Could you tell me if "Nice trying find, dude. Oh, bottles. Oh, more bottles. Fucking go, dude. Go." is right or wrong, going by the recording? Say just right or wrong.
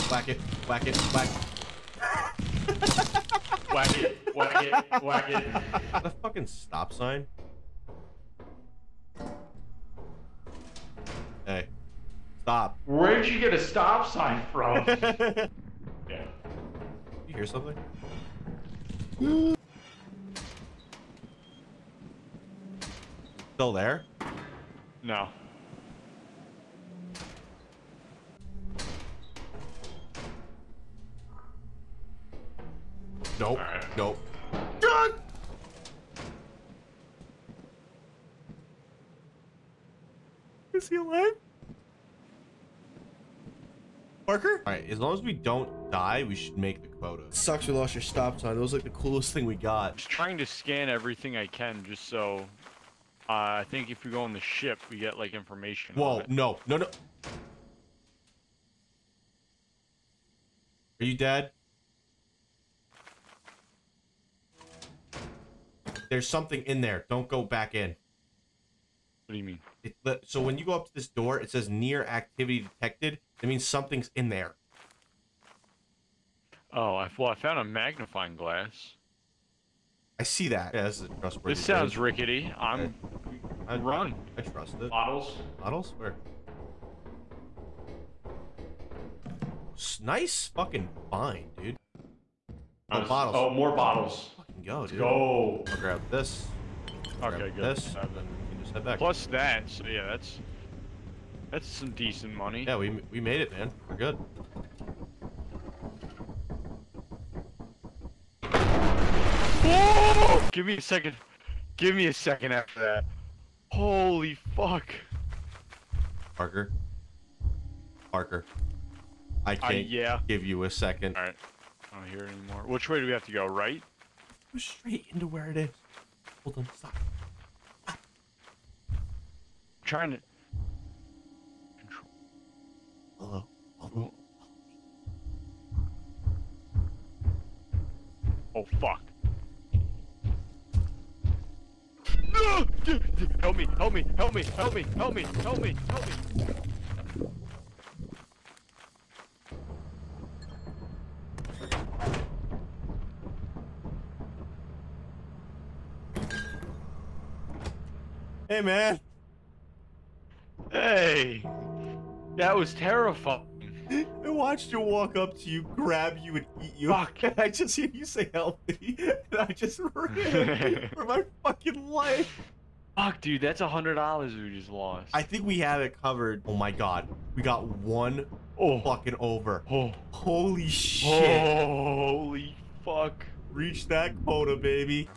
wrong.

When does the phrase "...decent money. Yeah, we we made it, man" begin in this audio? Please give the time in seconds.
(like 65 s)
101 s.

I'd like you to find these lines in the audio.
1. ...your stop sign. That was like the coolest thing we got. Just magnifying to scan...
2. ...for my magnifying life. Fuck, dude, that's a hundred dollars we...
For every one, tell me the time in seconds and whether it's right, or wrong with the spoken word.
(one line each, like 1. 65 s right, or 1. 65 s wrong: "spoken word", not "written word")
1. 47 s wrong: "trying", not "magnifying"
2. 170 s wrong: "fucking", not "magnifying".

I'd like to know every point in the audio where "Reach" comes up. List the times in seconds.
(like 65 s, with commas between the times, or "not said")
183 s.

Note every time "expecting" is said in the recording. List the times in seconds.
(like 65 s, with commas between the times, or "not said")
not said.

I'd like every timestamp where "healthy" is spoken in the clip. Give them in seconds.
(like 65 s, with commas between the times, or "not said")
168 s.